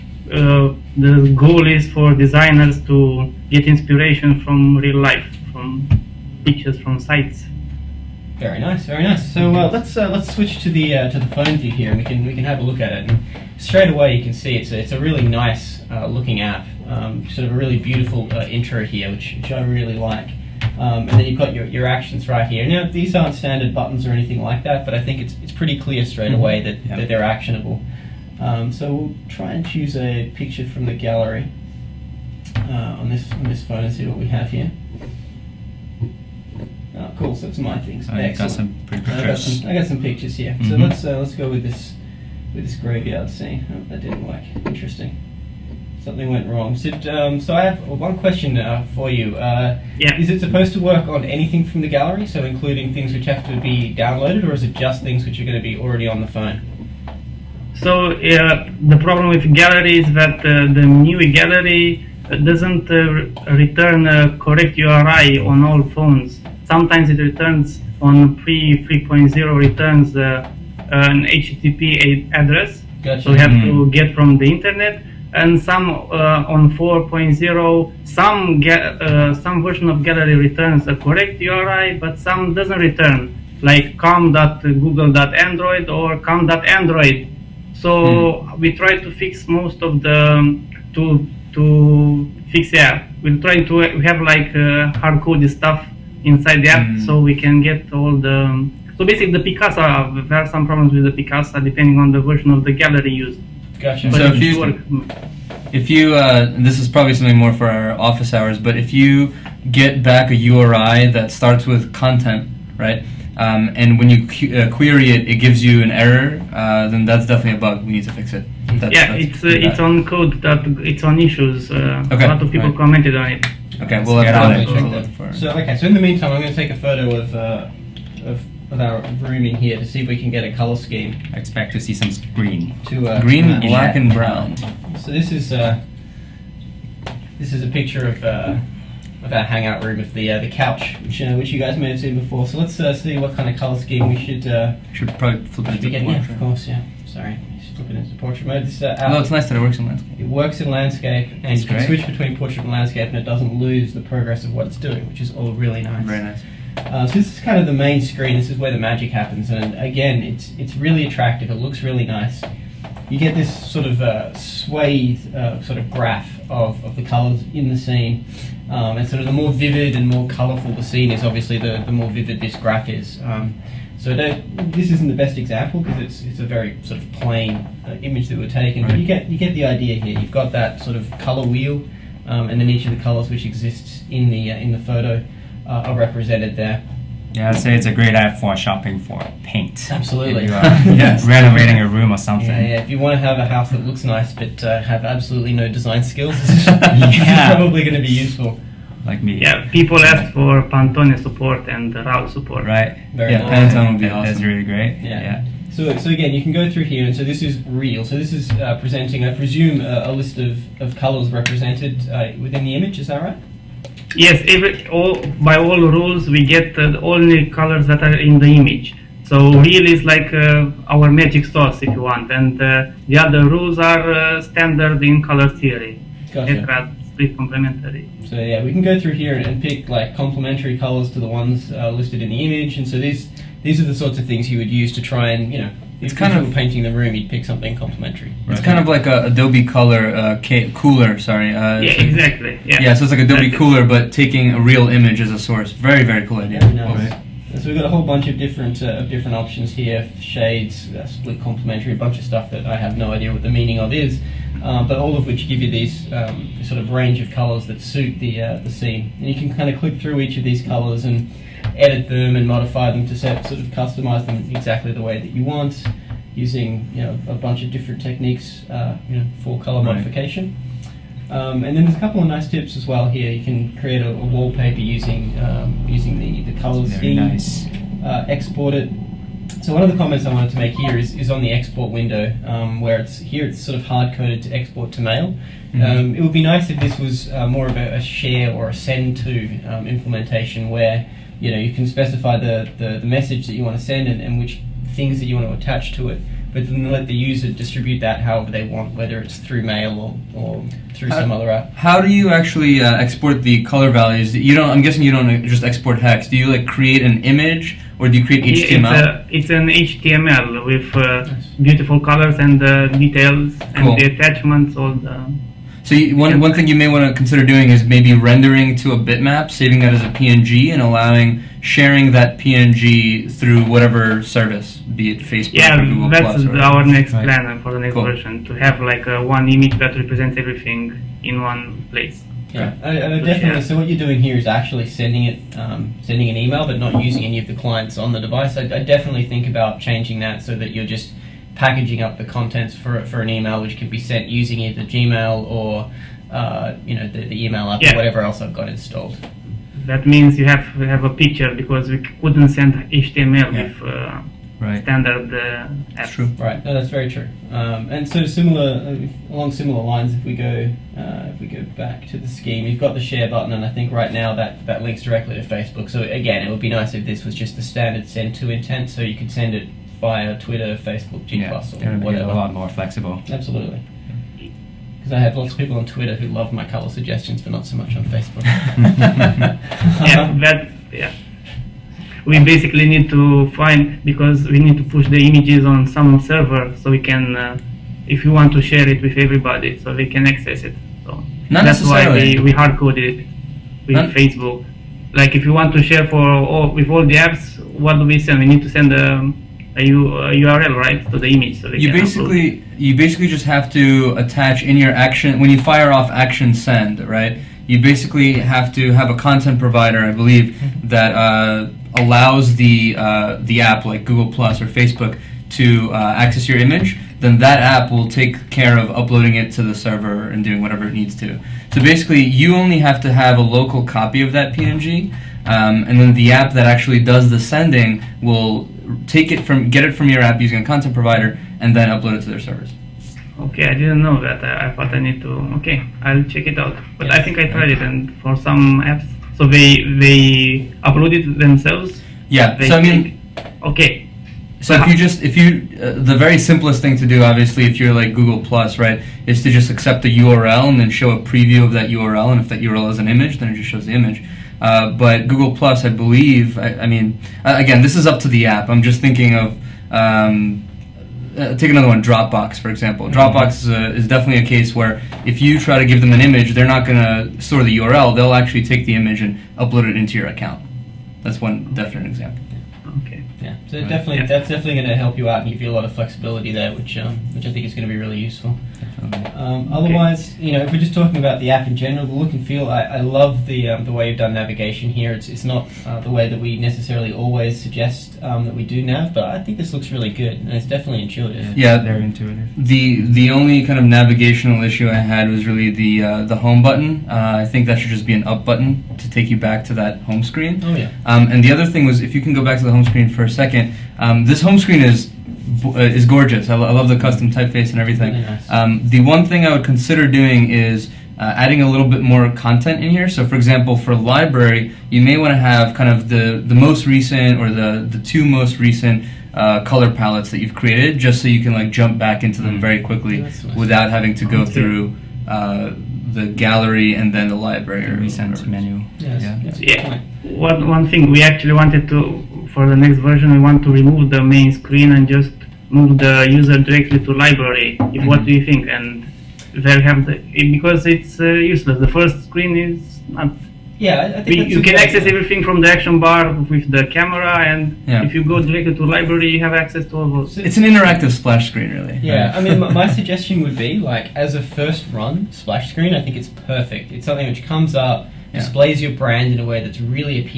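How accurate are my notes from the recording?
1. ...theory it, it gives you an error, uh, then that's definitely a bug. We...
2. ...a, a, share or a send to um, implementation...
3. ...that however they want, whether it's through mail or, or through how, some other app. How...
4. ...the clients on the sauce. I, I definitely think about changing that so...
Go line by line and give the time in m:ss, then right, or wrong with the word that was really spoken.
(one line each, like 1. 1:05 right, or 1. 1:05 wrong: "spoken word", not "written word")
1. 1:54 wrong: "query", not "theory"
2. 4:47 right
3. 4:57 right
4. 5:37 wrong: "device", not "sauce".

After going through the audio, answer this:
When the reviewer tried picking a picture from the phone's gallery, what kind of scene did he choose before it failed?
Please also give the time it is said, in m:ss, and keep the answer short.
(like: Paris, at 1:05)
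Graveyard scene, at 0:42.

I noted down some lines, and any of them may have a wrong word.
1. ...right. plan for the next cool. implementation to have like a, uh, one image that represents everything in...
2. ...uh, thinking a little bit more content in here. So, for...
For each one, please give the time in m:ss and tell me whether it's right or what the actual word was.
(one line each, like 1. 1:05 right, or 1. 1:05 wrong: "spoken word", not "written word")
1. 5:27 wrong: "version", not "implementation"
2. 8:31 wrong: "adding", not "thinking".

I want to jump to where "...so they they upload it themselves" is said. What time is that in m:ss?
7:19.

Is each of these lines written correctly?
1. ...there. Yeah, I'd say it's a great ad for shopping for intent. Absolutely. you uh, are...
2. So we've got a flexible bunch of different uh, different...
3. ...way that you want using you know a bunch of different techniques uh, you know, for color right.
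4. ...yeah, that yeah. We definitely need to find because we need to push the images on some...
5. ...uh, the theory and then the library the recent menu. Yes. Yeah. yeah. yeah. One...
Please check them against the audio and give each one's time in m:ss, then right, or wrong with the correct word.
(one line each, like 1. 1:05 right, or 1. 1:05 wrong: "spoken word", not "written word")
1. 3:06 wrong: "paint", not "intent"
2. 4:07 wrong: "whole", not "flexible"
3. 4:25 right
4. 6:18 wrong: "basically", not "definitely"
5. 8:45 wrong: "gallery", not "theory".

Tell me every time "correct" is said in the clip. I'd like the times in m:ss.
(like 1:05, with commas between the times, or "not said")
1:04, 1:20.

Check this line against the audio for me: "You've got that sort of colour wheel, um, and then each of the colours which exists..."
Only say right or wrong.
right.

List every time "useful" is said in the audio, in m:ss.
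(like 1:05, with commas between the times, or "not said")
3:18, 7:58.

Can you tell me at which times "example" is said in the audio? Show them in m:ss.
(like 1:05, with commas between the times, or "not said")
2:55, 7:42, 7:52, 8:33.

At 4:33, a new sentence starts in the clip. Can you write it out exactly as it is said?
You can create a, a wallpaper using um, using the, the color scheme.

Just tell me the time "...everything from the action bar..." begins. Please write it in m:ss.
9:05.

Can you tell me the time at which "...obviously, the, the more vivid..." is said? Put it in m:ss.
2:51.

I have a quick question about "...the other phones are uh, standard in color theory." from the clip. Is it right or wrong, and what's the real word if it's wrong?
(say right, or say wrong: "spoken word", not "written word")
wrong: "rules", not "phones".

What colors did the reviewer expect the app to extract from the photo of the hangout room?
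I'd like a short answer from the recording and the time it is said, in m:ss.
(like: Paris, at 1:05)
Green, black, and brown, at 2:13.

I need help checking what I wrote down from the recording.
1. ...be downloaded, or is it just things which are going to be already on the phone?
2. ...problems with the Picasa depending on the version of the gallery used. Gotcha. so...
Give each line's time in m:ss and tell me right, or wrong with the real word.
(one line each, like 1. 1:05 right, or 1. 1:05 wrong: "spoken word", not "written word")
1. 0:53 right
2. 1:40 right.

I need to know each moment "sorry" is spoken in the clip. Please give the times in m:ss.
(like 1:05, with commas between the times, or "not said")
2:27, 4:01.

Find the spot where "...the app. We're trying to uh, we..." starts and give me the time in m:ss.
1:32.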